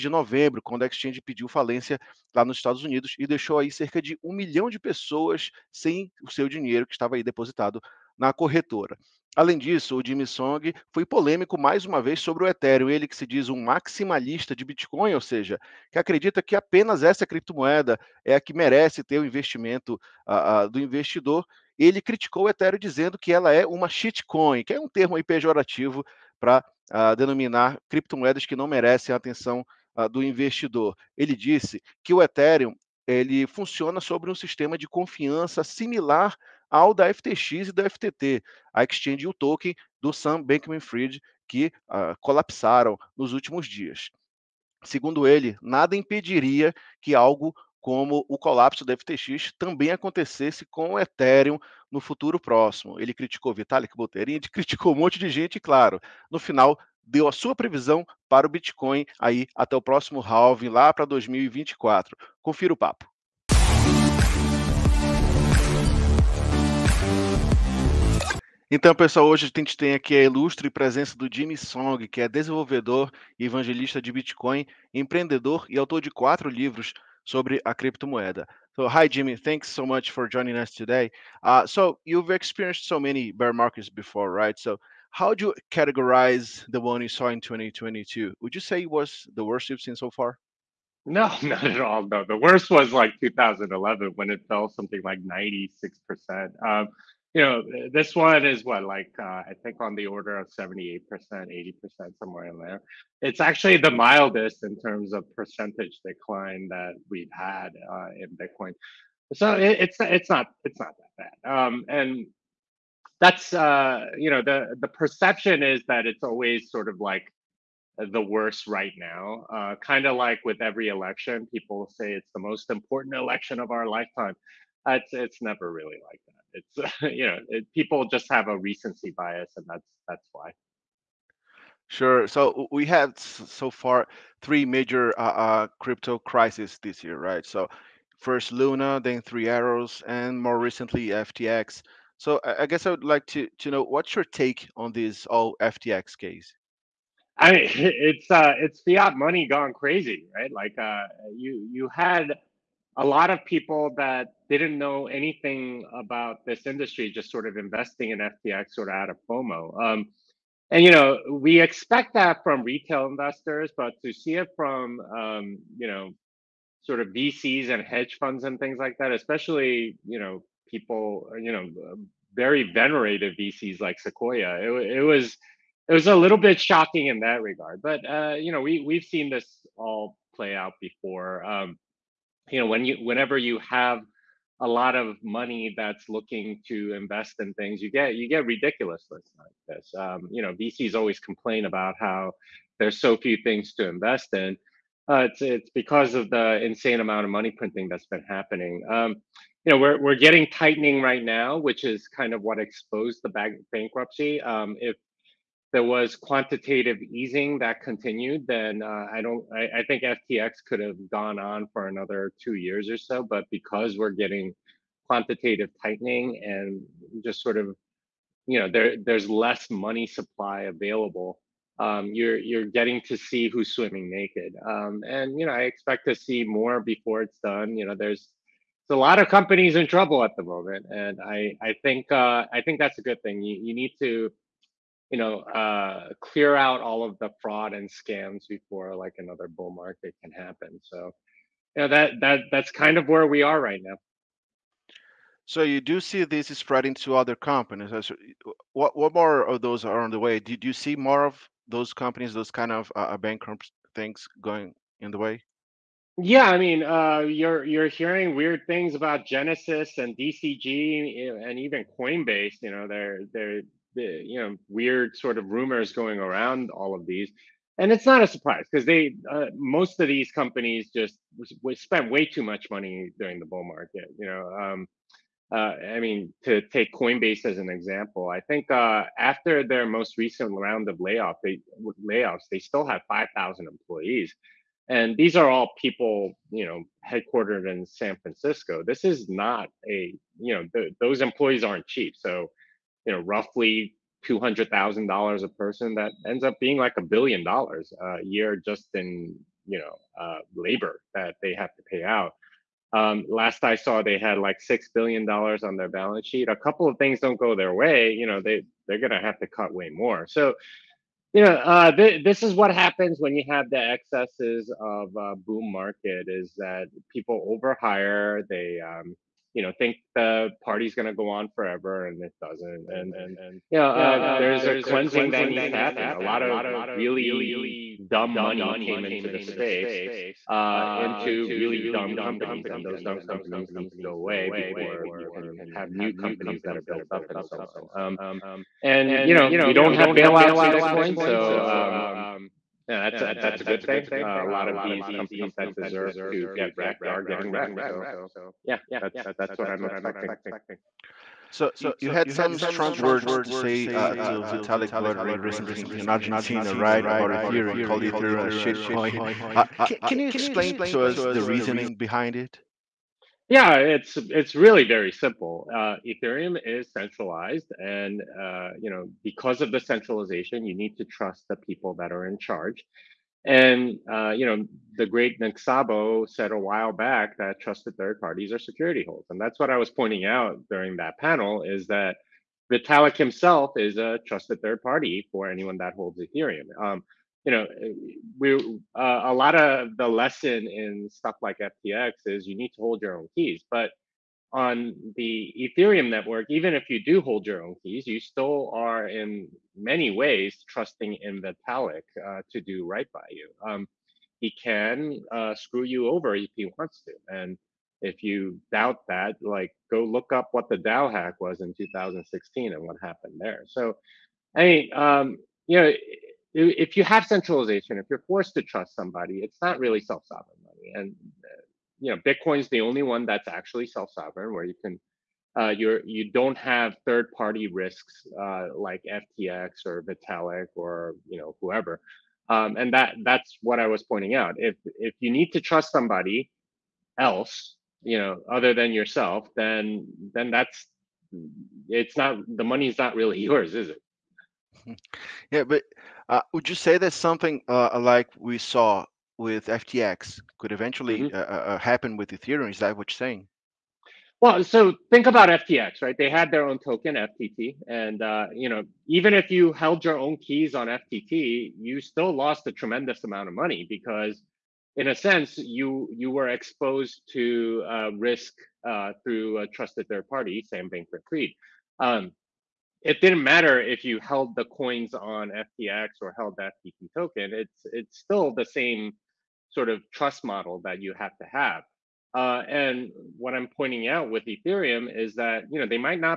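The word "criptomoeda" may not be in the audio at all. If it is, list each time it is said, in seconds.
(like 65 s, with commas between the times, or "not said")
17 s, 27 s, 77 s.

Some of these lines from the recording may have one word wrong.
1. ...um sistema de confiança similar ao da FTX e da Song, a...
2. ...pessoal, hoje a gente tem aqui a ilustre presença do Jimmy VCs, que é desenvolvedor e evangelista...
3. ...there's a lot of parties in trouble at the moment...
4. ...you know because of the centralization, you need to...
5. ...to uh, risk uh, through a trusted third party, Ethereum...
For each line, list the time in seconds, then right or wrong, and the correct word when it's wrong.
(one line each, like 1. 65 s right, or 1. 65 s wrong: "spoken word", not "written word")
1. 34 s wrong: "FTT", not "Song"
2. 68 s wrong: "Song", not "VCs"
3. 227 s wrong: "companies", not "parties"
4. 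368 s right
5. 467 s wrong: "Sam", not "Ethereum".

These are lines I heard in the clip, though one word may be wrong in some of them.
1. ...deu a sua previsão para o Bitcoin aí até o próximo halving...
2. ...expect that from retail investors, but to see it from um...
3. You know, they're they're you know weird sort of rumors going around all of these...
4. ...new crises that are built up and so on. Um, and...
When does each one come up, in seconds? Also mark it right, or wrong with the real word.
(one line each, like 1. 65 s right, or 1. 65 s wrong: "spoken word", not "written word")
1. 57 s right
2. 161 s right
3. 262 s right
4. 335 s wrong: "companies", not "crises".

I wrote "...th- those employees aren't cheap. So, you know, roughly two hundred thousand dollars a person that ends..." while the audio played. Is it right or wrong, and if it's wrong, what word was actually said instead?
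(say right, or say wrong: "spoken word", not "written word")
right.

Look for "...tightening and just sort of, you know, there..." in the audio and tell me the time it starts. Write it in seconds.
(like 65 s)
215 s.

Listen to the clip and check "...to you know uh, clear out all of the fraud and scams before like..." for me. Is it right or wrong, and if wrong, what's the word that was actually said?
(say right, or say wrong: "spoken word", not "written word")
right.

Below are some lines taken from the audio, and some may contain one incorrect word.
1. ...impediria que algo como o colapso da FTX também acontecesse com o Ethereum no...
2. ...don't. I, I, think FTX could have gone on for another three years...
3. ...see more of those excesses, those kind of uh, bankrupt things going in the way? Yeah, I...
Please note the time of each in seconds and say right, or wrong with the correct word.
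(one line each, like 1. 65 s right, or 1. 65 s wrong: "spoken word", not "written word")
1. 45 s right
2. 209 s wrong: "two", not "three"
3. 250 s wrong: "companies", not "excesses".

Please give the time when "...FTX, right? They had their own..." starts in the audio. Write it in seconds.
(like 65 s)
455 s.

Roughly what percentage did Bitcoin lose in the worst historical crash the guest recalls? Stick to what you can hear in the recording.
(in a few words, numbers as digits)
96%.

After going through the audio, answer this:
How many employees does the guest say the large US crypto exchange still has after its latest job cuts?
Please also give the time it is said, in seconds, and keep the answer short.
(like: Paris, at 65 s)
5,000, at 283 s.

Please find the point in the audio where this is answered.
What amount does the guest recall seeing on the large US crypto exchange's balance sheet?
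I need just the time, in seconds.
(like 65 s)
304 s.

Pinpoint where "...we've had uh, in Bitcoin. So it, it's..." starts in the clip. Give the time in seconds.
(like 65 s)
107 s.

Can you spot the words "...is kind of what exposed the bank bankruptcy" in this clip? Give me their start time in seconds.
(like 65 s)
201 s.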